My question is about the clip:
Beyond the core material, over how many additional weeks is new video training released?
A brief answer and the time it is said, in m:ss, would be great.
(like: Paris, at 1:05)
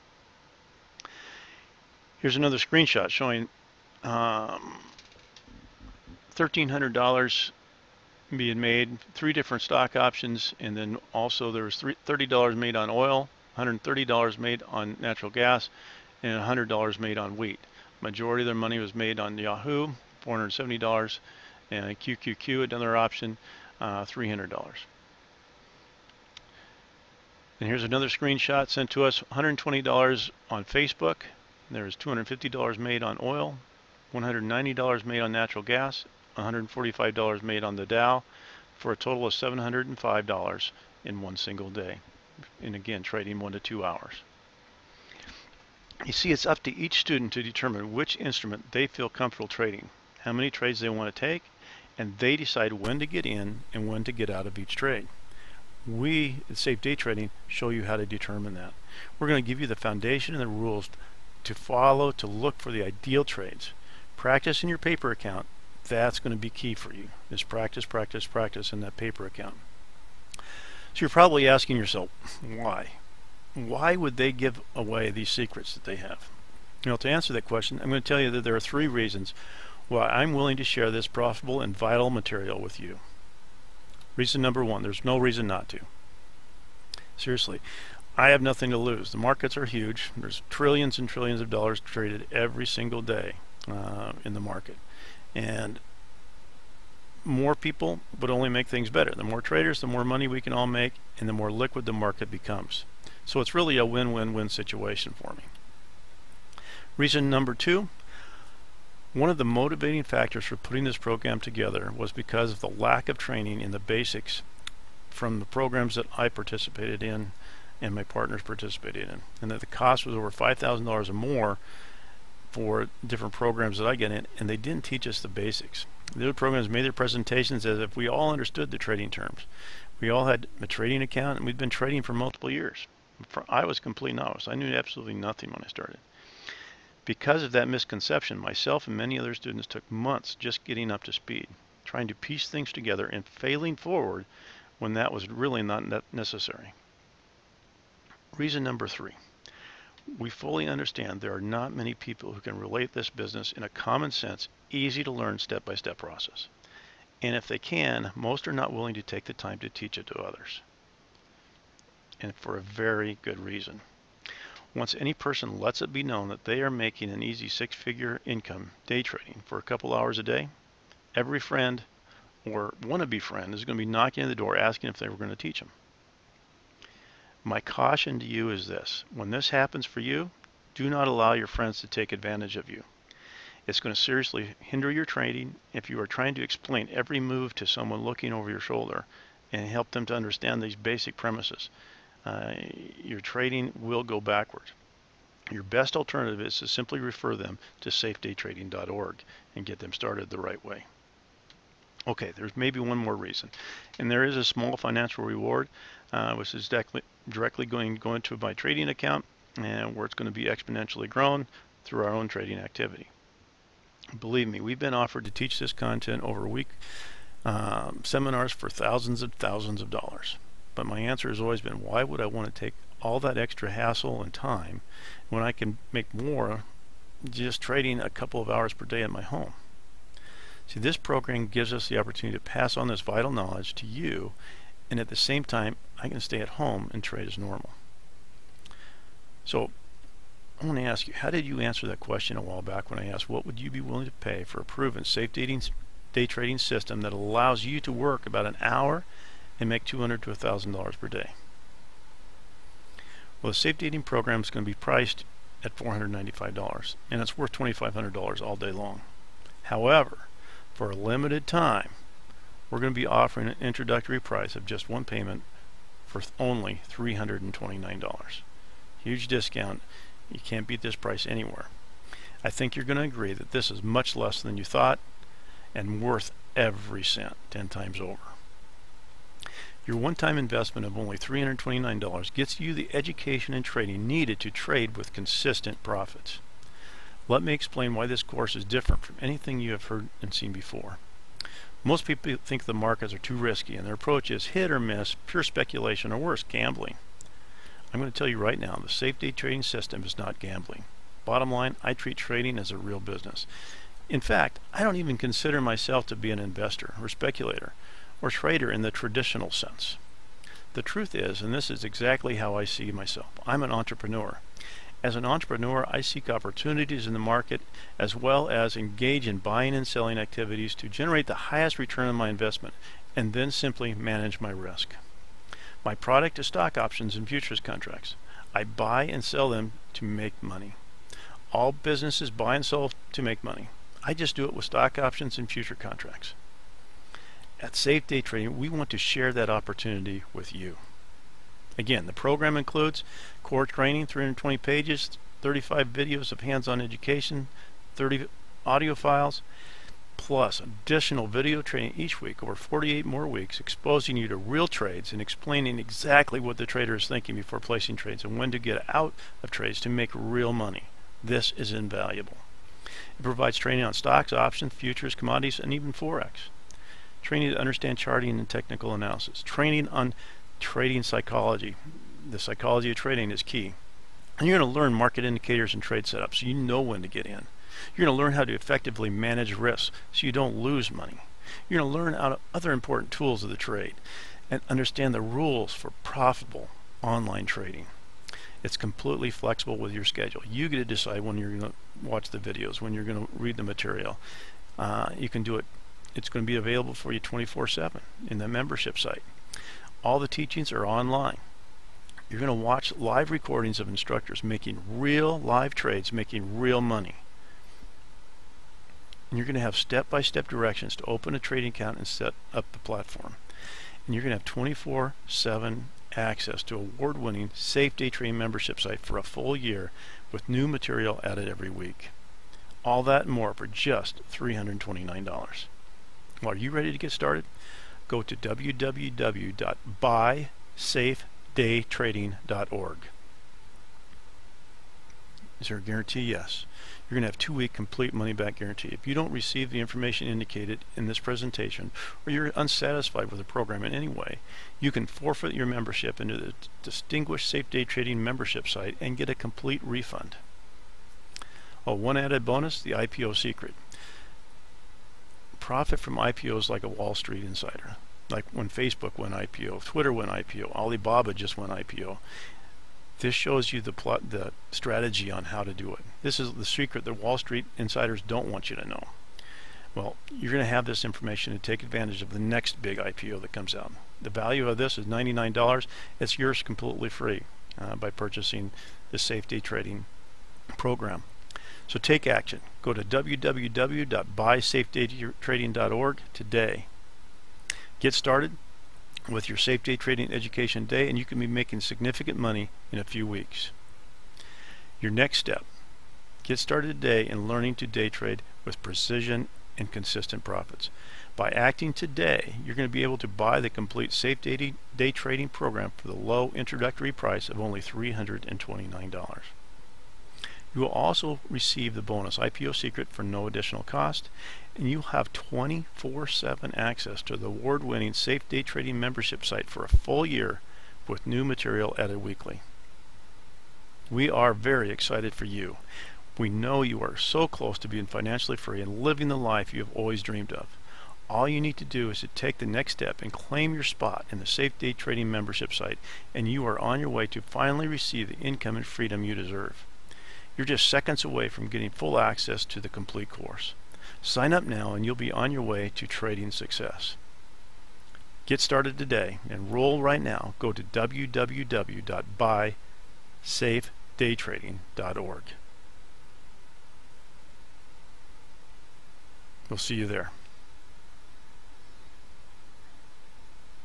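48, at 5:52.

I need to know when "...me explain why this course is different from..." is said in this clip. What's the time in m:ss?
4:47.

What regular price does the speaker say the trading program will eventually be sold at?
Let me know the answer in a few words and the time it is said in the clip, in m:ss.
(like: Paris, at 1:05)
$495, at 4:15.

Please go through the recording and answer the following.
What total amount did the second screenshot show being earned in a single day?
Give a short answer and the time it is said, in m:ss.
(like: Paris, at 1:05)
$705, at 0:39.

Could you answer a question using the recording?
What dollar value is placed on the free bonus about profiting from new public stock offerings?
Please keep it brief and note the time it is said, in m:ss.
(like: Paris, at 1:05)
$99, at 7:55.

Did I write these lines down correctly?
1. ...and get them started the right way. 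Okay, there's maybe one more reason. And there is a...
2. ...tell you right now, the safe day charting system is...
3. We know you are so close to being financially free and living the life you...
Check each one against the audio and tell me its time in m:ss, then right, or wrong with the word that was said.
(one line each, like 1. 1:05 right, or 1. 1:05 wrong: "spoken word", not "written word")
1. 3:19 right
2. 4:58 wrong: "trading", not "charting"
3. 8:46 right.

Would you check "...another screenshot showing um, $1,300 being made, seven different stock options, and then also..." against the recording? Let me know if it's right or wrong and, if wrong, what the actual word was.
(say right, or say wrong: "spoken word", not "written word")
wrong: "three", not "seven".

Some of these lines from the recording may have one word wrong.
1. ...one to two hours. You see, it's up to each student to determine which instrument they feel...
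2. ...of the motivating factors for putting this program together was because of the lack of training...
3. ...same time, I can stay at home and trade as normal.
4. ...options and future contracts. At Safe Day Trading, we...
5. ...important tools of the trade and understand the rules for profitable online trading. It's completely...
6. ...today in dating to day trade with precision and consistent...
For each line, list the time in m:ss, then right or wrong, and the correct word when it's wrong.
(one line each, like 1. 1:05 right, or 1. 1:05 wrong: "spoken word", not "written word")
1. 0:43 right
2. 1:49 right
3. 3:55 right
4. 5:34 right
5. 6:22 right
6. 8:17 wrong: "learning", not "dating".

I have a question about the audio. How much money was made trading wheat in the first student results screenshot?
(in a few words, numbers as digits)
$100.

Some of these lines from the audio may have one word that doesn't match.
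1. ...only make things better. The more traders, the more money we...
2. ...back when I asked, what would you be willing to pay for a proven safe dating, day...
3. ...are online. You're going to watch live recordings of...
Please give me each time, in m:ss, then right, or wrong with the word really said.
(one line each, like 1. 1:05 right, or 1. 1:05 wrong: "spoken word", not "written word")
1. 1:38 right
2. 4:02 right
3. 6:40 right.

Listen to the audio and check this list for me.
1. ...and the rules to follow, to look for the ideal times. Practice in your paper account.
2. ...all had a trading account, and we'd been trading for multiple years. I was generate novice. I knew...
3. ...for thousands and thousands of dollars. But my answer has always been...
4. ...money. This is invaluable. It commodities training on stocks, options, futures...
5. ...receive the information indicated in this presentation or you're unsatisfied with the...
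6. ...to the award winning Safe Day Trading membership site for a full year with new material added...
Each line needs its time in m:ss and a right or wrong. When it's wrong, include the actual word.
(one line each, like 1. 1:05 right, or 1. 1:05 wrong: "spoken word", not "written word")
1. 1:00 wrong: "trades", not "times"
2. 2:10 wrong: "complete", not "generate"
3. 3:38 right
4. 6:00 wrong: "provides", not "commodities"
5. 7:19 right
6. 8:37 right.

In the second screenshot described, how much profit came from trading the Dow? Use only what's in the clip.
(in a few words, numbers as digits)
$145.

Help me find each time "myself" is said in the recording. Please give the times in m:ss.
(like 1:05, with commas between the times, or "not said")
2:18, 5:05, 5:12.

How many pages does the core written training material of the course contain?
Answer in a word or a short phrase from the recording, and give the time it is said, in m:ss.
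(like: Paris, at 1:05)
320, at 5:44.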